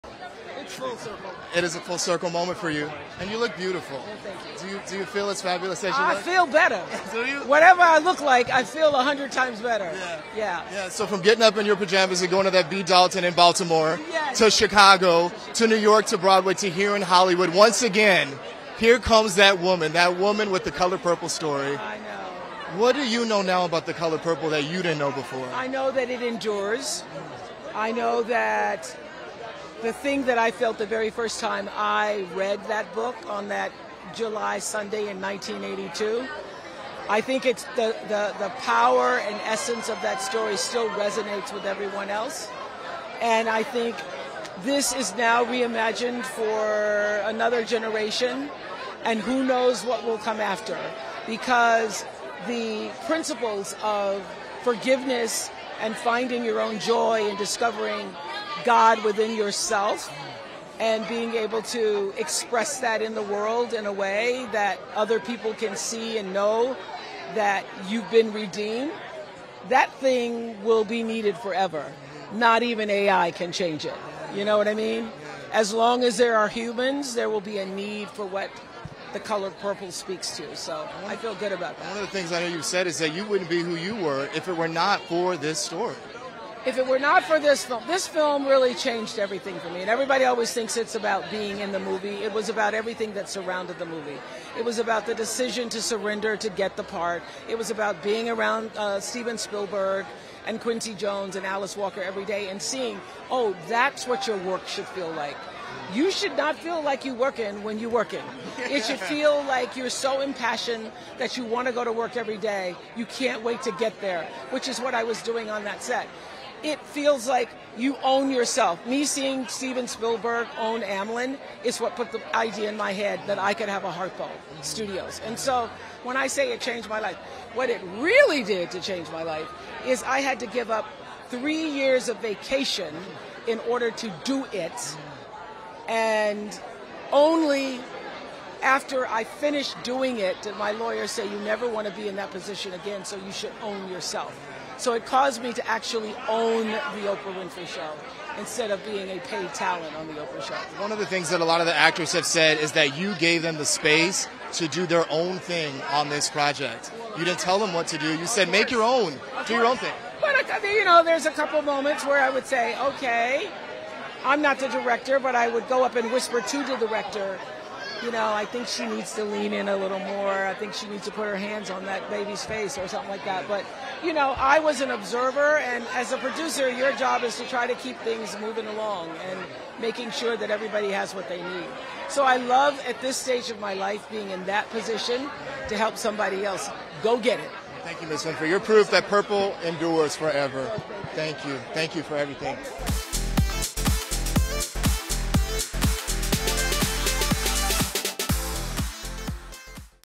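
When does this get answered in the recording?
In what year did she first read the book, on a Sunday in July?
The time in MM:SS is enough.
00:35.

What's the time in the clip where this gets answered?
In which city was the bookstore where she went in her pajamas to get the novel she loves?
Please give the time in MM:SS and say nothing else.
00:13.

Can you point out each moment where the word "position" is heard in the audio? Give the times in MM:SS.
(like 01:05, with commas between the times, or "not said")
02:22, 03:04.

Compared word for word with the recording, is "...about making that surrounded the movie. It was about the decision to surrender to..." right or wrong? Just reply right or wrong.
wrong.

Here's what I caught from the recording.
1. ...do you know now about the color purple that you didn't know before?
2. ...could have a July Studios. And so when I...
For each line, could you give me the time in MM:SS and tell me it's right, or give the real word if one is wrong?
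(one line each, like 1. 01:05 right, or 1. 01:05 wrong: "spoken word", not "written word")
1. 00:22 right
2. 02:03 wrong: "Harpo", not "July".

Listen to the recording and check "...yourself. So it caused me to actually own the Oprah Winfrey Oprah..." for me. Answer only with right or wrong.
wrong.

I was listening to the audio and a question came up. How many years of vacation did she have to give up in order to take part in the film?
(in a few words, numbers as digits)
3.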